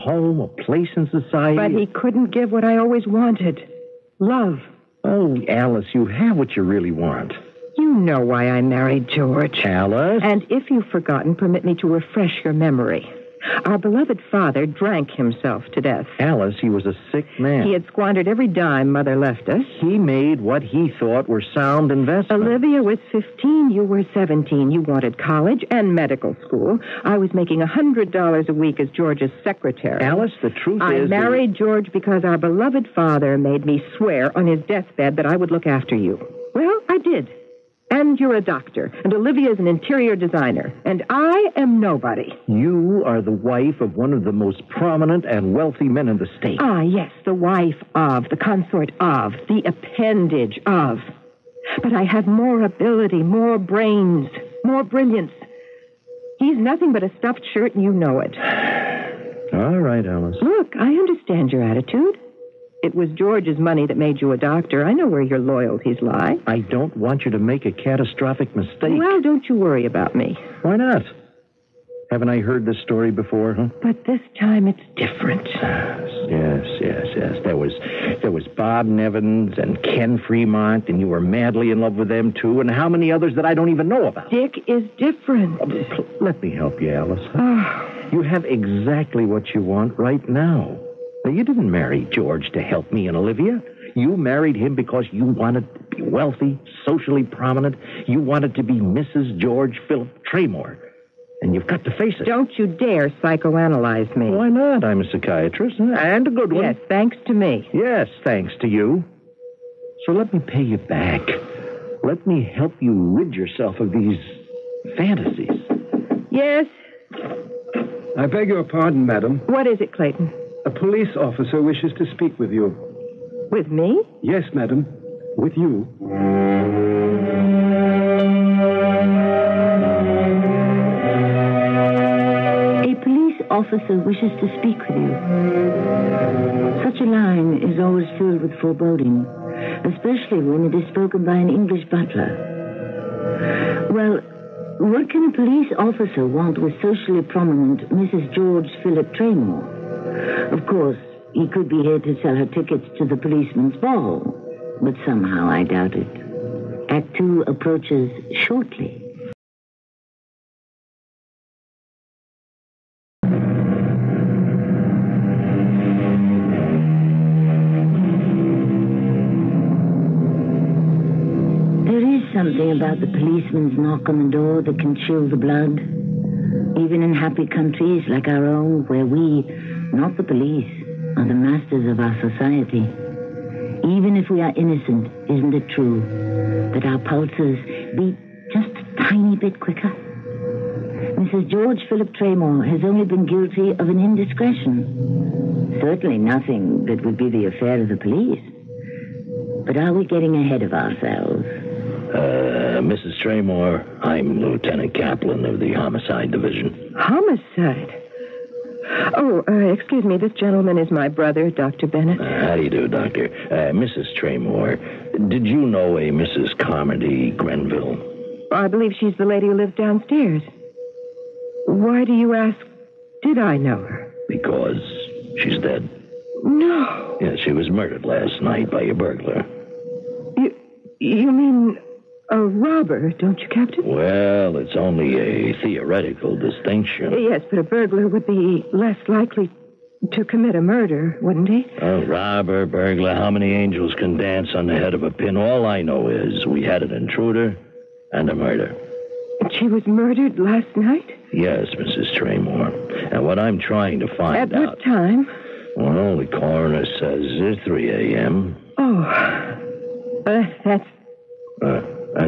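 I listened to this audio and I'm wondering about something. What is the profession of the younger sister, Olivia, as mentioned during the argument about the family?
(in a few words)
interior designer.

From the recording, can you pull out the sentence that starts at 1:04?
I know where your loyalties lie.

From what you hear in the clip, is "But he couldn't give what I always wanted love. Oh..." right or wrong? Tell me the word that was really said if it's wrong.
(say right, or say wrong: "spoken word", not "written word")
right.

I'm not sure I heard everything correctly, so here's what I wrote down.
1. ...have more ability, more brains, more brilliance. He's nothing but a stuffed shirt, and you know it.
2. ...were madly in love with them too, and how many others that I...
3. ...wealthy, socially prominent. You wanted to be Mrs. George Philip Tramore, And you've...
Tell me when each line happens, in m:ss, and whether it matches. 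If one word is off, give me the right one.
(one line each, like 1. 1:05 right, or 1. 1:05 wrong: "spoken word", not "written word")
1. 0:52 right
2. 1:21 right
3. 1:36 right.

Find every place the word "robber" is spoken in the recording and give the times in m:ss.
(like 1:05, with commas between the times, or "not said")
3:52, 4:02.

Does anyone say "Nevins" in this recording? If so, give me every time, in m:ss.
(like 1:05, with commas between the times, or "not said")
1:18.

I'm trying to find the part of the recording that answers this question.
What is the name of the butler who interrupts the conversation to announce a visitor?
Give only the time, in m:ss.
1:59.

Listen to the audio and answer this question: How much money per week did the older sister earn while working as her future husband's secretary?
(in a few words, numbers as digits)
$100.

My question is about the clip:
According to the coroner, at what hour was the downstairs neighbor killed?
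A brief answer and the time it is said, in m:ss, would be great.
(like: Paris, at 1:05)
3 a.m., at 4:17.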